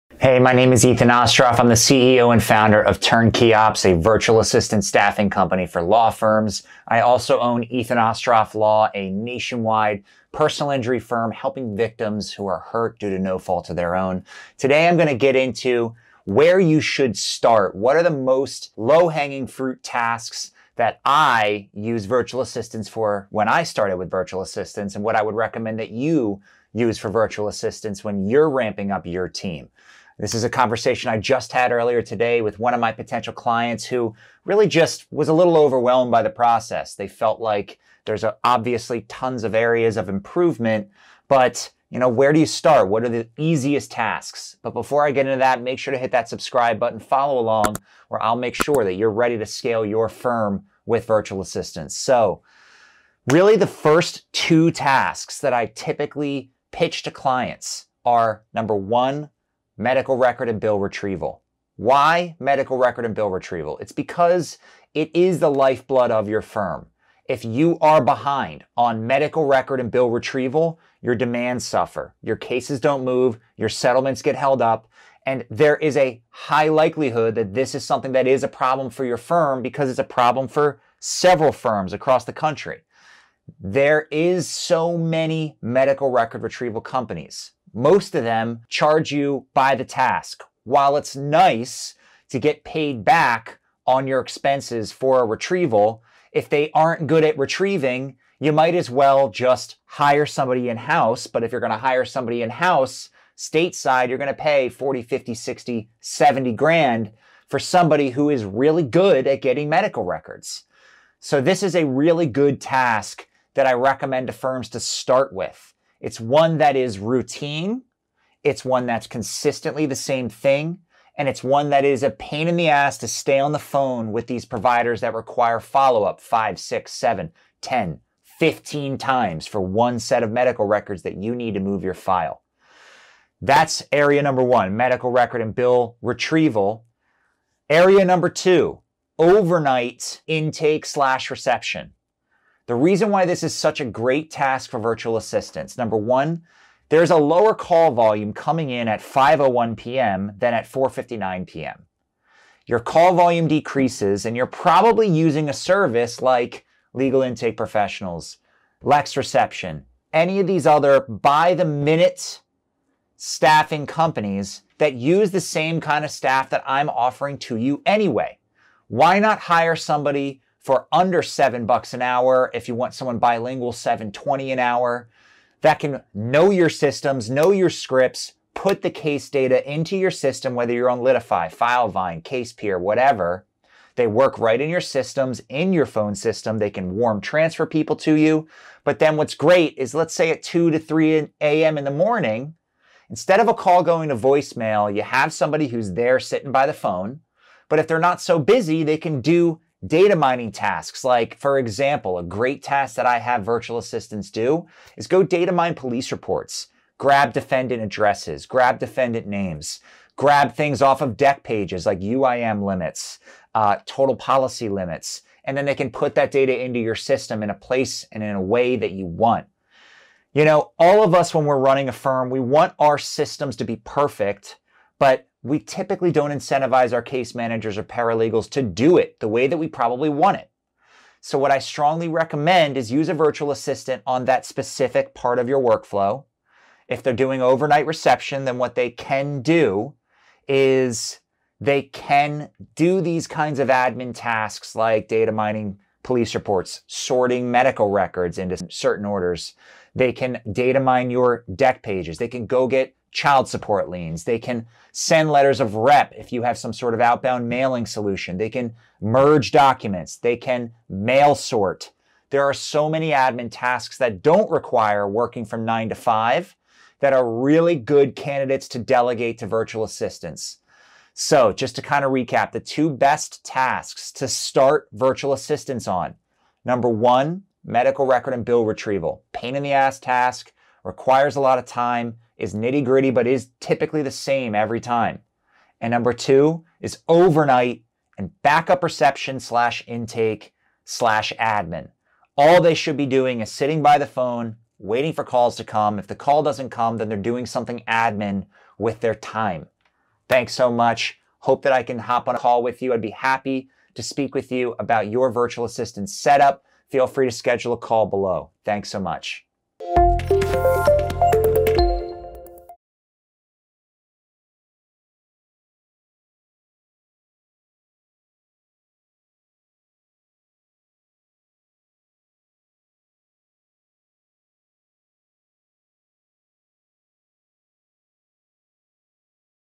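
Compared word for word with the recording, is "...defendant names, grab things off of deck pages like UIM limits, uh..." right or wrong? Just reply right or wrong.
right.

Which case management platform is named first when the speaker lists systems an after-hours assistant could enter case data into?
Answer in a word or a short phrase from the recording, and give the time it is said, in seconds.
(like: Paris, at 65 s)
Litify, at 180 s.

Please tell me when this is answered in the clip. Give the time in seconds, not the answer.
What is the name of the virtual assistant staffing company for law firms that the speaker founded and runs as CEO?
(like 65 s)
2 s.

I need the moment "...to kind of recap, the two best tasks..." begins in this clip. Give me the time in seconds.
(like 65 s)
271 s.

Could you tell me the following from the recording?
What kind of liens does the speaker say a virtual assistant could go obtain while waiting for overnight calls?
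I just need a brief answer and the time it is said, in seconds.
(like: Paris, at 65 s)
Child support liens, at 253 s.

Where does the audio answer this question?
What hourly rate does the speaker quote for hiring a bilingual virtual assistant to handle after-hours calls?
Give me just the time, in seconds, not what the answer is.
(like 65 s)
173 s.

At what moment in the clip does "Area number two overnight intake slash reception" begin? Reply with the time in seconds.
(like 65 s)
137 s.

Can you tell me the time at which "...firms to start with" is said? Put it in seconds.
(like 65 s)
114 s.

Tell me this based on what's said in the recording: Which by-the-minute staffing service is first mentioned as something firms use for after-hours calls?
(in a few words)
Legal Intake Professionals.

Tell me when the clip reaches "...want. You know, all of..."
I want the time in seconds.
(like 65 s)
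219 s.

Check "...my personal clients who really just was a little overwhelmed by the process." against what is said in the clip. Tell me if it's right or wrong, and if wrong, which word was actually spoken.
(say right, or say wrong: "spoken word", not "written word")
wrong: "potential", not "personal".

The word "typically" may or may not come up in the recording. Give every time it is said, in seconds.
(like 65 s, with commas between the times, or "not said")
55 s, 225 s, 283 s.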